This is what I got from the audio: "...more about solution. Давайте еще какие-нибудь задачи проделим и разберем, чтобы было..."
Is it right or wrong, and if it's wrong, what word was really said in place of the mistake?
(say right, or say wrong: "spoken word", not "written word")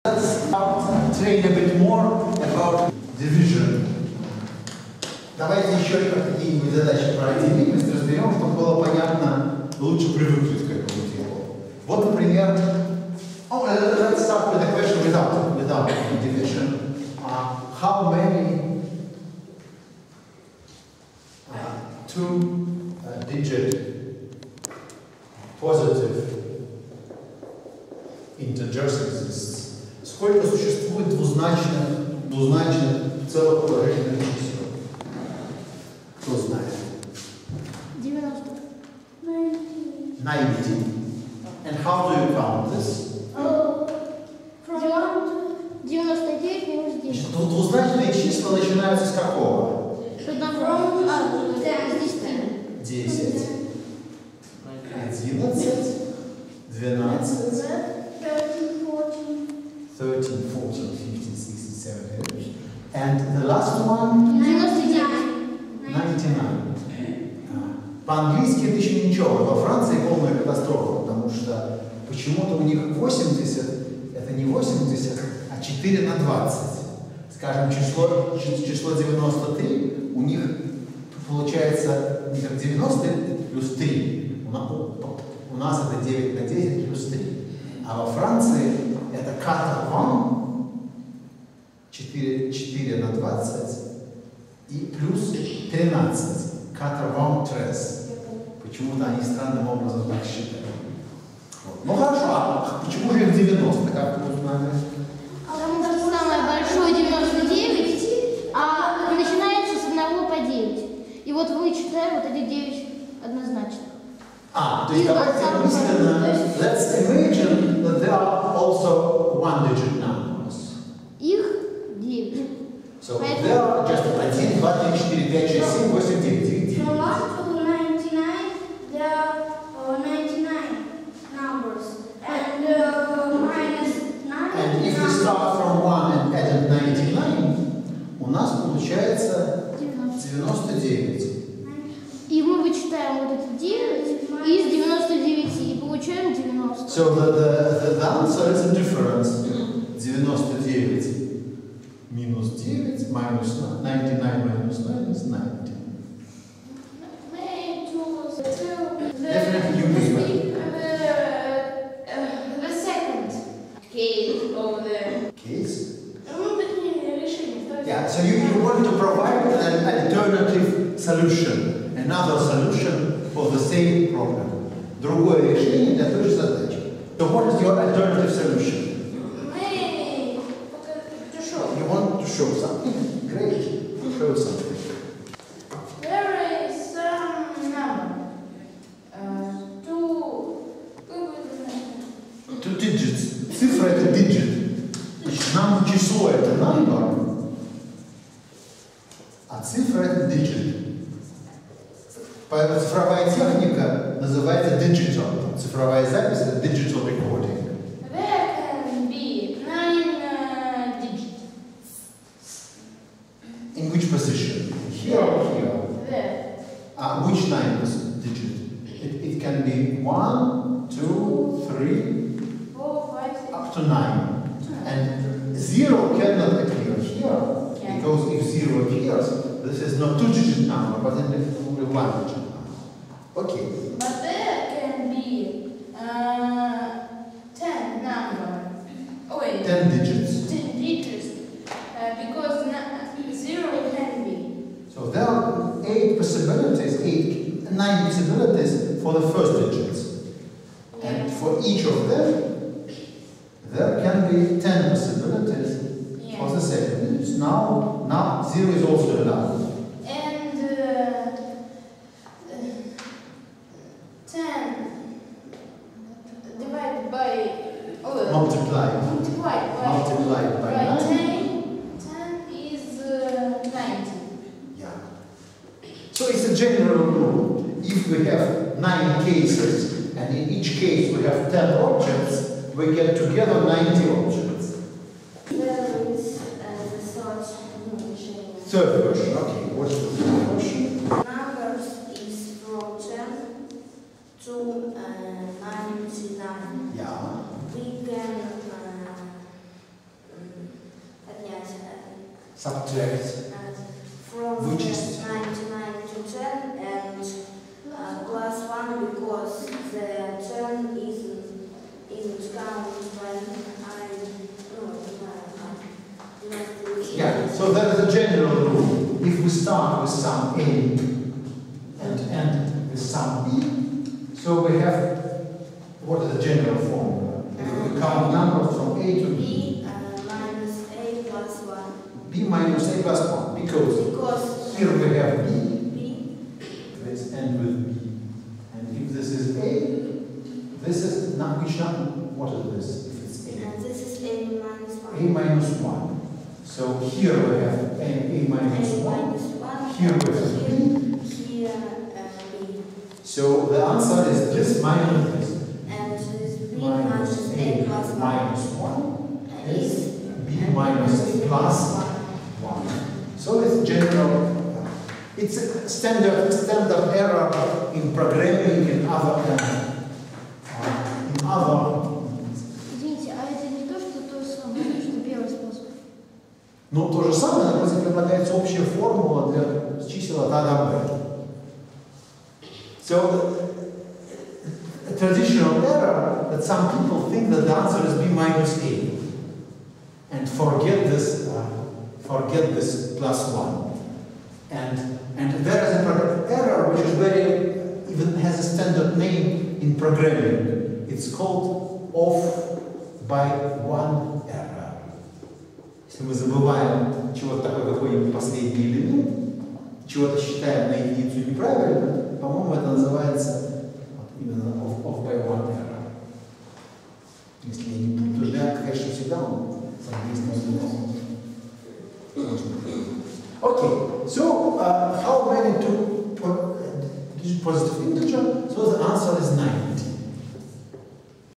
wrong: "division", not "solution".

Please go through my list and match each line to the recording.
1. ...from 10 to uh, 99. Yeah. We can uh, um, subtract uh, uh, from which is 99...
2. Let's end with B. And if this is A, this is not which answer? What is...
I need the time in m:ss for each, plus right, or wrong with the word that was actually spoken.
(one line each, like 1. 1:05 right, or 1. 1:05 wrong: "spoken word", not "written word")
1. 4:52 right
2. 5:37 wrong: "number", not "answer".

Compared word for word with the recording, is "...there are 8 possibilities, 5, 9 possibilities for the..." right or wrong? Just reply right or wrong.
wrong.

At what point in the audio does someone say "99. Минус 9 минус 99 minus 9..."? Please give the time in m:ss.
2:29.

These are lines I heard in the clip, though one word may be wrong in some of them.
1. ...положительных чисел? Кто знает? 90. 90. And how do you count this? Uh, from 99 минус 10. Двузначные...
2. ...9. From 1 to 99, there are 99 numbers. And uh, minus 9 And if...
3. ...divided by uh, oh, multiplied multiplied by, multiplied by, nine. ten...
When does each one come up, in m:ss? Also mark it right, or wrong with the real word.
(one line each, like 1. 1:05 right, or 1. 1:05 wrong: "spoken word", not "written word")
1. 0:33 right
2. 2:06 right
3. 4:26 right.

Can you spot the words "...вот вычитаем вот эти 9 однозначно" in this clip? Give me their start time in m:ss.
1:51.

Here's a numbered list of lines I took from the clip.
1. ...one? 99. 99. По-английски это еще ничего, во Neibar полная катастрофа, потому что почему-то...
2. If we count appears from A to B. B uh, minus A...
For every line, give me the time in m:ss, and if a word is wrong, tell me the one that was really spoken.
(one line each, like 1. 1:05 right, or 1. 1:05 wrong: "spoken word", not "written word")
1. 1:03 wrong: "Франции", not "Neibar"
2. 5:27 wrong: "numbers", not "appears".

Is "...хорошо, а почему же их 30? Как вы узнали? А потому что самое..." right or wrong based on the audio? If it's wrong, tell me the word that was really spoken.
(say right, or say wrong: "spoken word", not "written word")
wrong: "90", not "30".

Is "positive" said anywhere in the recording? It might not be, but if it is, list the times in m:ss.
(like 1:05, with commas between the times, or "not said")
0:25, 7:07.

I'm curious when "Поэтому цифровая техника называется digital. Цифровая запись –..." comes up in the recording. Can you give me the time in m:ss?
3:22.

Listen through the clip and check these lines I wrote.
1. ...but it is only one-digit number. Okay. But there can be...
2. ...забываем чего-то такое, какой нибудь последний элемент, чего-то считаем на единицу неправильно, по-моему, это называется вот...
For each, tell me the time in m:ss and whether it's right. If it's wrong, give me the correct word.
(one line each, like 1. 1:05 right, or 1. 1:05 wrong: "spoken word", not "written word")
1. 3:50 right
2. 6:46 right.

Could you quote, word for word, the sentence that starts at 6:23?
So, traditional error that some people think that the answer is B minus A and forget this, uh, forget this plus one.